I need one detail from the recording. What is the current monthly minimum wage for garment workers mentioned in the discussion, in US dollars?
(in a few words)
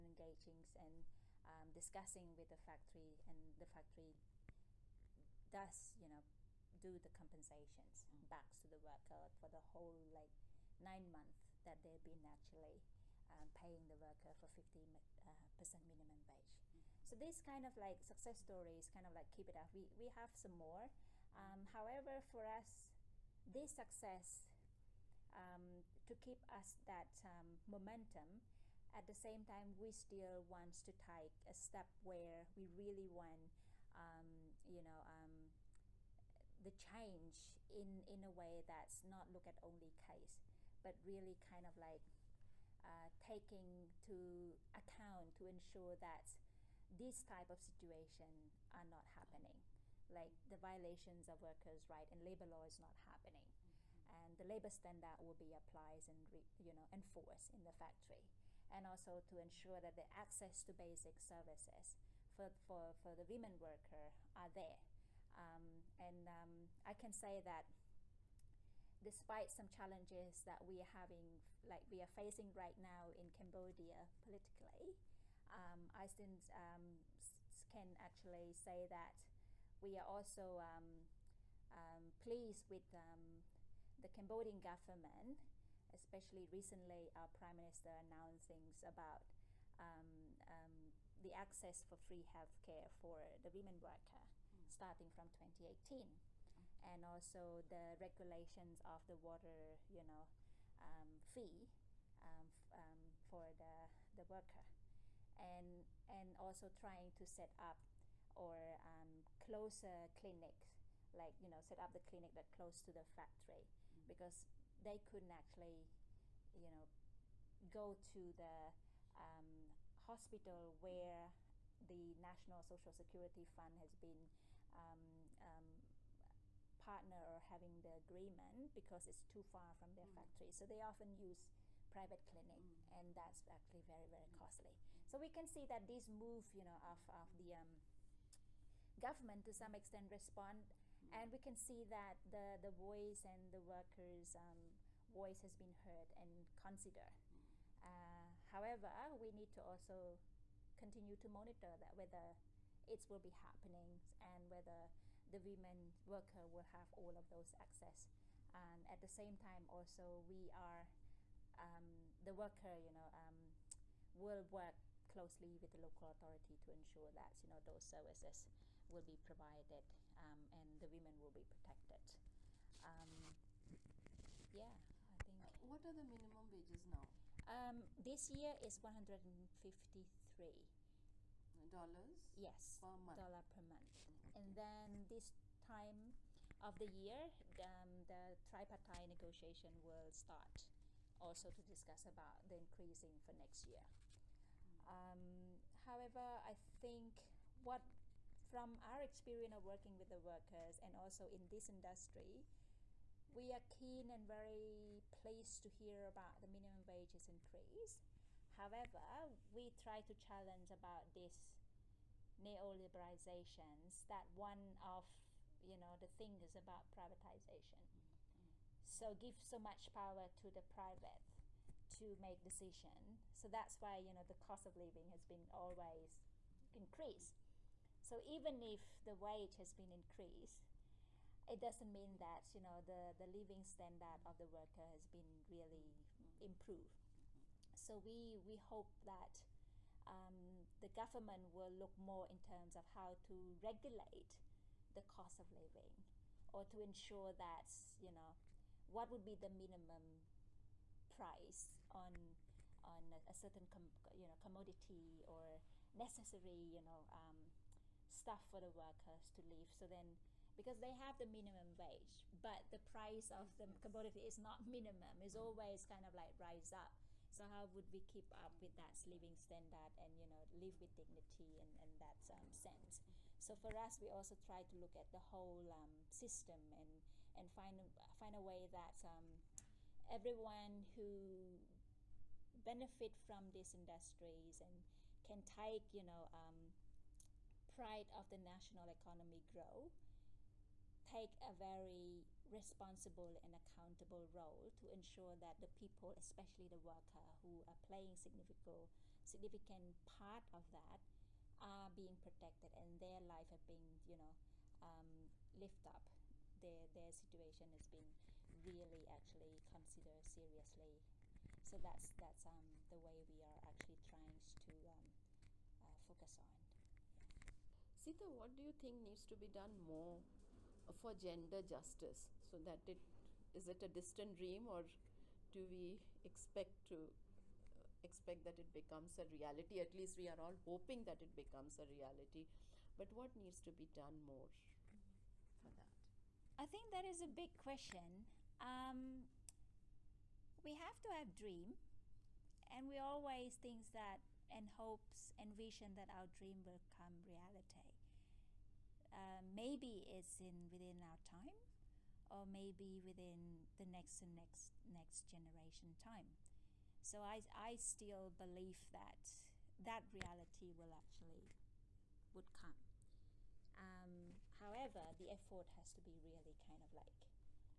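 $153.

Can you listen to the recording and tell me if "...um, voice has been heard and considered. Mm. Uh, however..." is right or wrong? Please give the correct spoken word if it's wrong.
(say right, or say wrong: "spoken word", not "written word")
right.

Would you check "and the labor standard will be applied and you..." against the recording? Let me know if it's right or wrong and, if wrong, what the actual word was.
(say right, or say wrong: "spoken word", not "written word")
right.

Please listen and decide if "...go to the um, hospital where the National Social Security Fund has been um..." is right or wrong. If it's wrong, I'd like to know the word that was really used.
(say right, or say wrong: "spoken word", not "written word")
right.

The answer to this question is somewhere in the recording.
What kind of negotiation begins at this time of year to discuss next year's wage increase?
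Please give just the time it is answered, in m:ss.
3:08.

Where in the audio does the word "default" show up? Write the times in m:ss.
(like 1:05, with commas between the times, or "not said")
not said.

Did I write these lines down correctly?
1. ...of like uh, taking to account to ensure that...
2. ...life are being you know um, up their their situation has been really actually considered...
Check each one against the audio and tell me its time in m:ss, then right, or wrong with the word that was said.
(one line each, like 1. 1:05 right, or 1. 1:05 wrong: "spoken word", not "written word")
1. 0:41 right
2. 5:03 right.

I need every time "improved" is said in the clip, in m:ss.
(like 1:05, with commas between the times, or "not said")
3:56.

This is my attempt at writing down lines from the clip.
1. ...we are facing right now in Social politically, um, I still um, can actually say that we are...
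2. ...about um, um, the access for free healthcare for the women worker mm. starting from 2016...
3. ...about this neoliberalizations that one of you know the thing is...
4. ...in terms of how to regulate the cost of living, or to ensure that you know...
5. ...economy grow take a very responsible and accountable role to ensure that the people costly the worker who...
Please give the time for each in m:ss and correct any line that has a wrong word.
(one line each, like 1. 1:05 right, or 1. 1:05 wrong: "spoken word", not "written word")
1. 1:11 wrong: "Cambodia", not "Social"
2. 1:28 wrong: "2018", not "2016"
3. 3:30 right
4. 4:02 right
5. 4:48 wrong: "especially", not "costly".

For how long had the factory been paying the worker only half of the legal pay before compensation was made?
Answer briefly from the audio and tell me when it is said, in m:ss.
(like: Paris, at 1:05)
9 months, at 0:10.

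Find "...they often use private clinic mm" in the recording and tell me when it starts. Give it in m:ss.
2:10.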